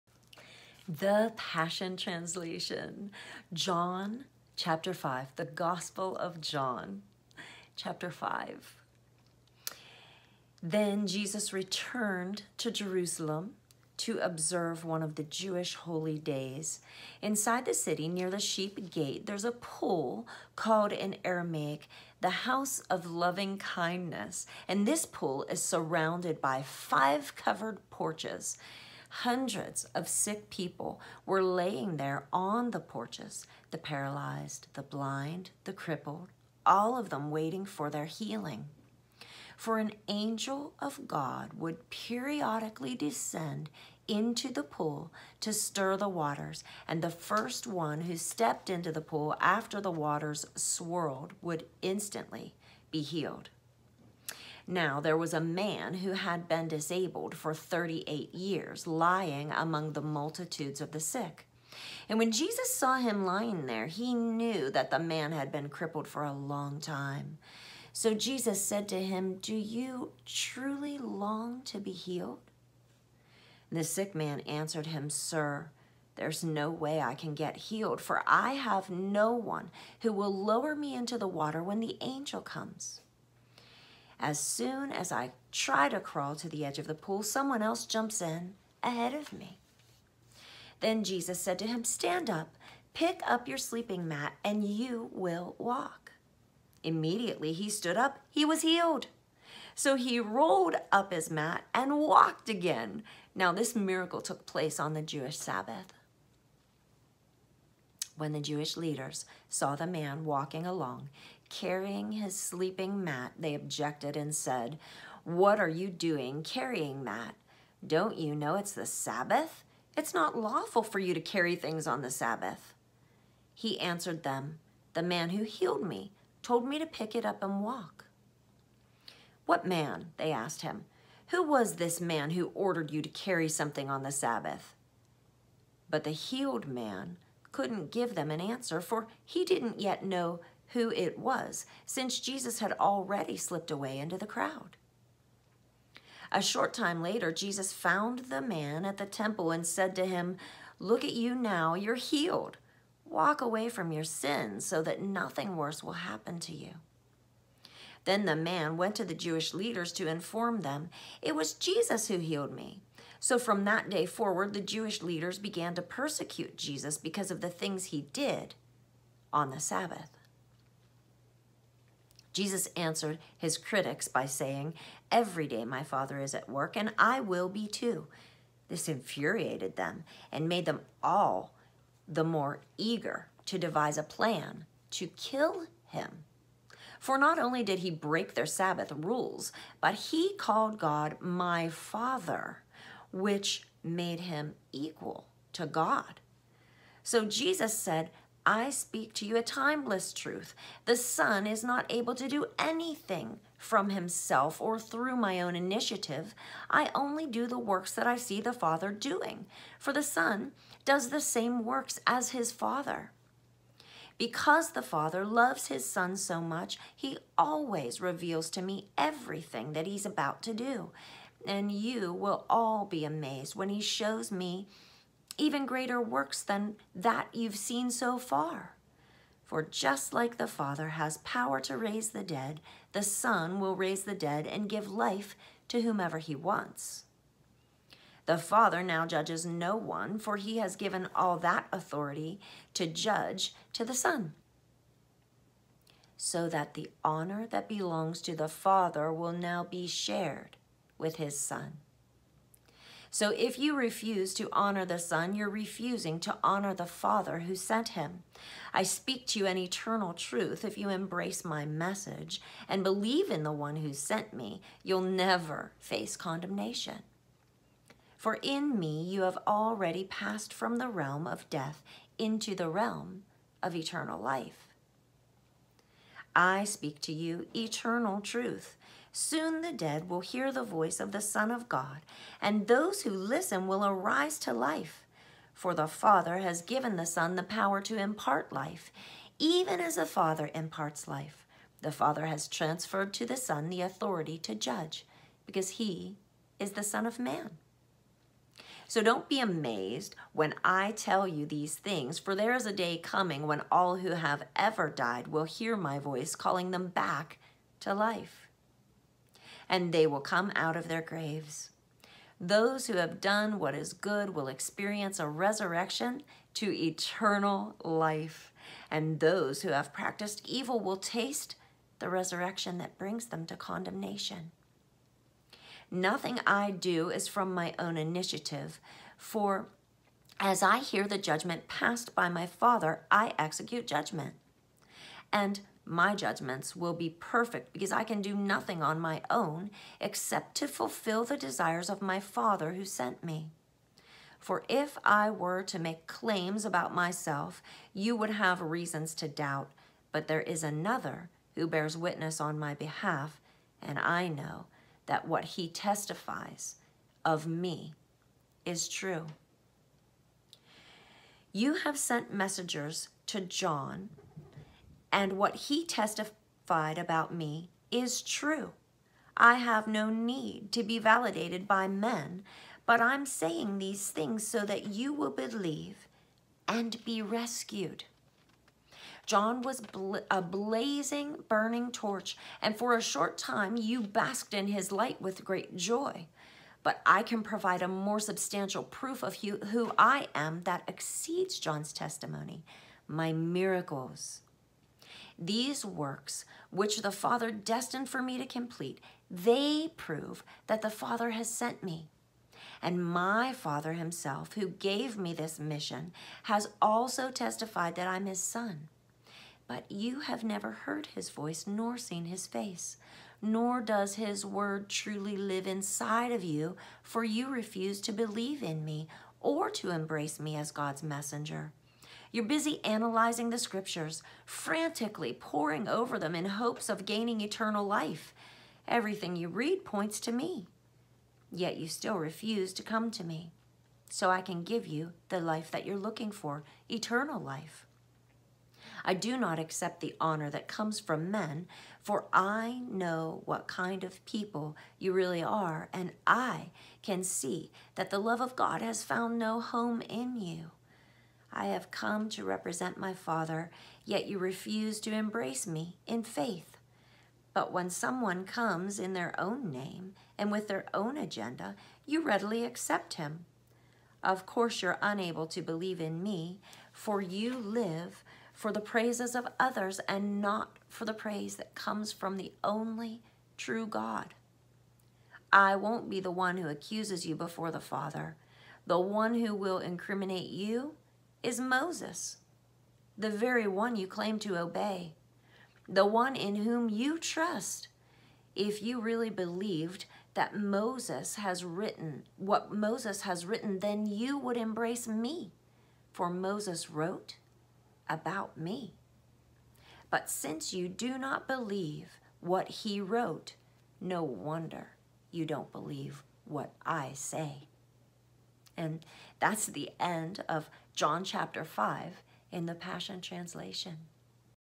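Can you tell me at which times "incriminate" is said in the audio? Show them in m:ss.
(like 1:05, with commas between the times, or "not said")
7:59.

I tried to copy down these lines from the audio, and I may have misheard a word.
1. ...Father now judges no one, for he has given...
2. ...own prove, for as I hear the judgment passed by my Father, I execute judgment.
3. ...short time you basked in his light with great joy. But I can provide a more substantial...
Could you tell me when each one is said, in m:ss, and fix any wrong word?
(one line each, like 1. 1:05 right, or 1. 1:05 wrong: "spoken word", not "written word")
1. 3:58 right
2. 5:27 wrong: "initiative", not "prove"
3. 6:23 right.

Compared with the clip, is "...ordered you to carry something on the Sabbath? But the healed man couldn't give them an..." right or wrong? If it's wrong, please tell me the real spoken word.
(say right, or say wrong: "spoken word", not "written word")
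right.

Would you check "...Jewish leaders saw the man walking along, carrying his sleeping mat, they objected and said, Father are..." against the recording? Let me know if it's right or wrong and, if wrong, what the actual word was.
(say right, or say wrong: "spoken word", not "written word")
wrong: "What", not "Father".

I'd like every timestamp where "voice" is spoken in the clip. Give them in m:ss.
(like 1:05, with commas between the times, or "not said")
4:40, 5:05, 6:51.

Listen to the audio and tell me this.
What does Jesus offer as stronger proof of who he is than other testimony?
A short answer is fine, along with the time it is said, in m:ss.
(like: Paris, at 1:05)
my miracles, at 6:33.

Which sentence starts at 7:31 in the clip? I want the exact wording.
I have come to represent my Father, yet you refuse to embrace me in faith.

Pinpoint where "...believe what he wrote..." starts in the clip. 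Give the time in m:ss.
8:21.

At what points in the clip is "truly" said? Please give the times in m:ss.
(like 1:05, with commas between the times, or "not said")
1:10, 6:54.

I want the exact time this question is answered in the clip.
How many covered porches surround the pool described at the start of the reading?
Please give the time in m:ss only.
0:26.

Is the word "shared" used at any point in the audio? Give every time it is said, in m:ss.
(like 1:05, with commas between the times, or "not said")
4:09.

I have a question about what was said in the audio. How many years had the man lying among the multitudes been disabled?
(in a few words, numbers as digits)
38.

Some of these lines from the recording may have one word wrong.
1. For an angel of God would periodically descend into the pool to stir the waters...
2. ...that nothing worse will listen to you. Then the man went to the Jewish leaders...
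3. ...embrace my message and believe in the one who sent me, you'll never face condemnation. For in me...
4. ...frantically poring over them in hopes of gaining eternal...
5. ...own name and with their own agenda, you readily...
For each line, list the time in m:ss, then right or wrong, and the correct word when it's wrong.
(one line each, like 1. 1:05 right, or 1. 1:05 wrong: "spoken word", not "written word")
1. 0:39 right
2. 2:34 wrong: "happen", not "listen"
3. 4:20 right
4. 7:04 right
5. 7:39 right.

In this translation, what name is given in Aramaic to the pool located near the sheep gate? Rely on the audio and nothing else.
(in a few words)
the house of loving kindness.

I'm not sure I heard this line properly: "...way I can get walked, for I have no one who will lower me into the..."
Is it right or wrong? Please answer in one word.
wrong.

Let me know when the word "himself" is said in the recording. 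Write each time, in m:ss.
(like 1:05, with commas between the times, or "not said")
3:23, 6:43.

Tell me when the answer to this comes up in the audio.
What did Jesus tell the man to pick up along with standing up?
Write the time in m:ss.
1:33.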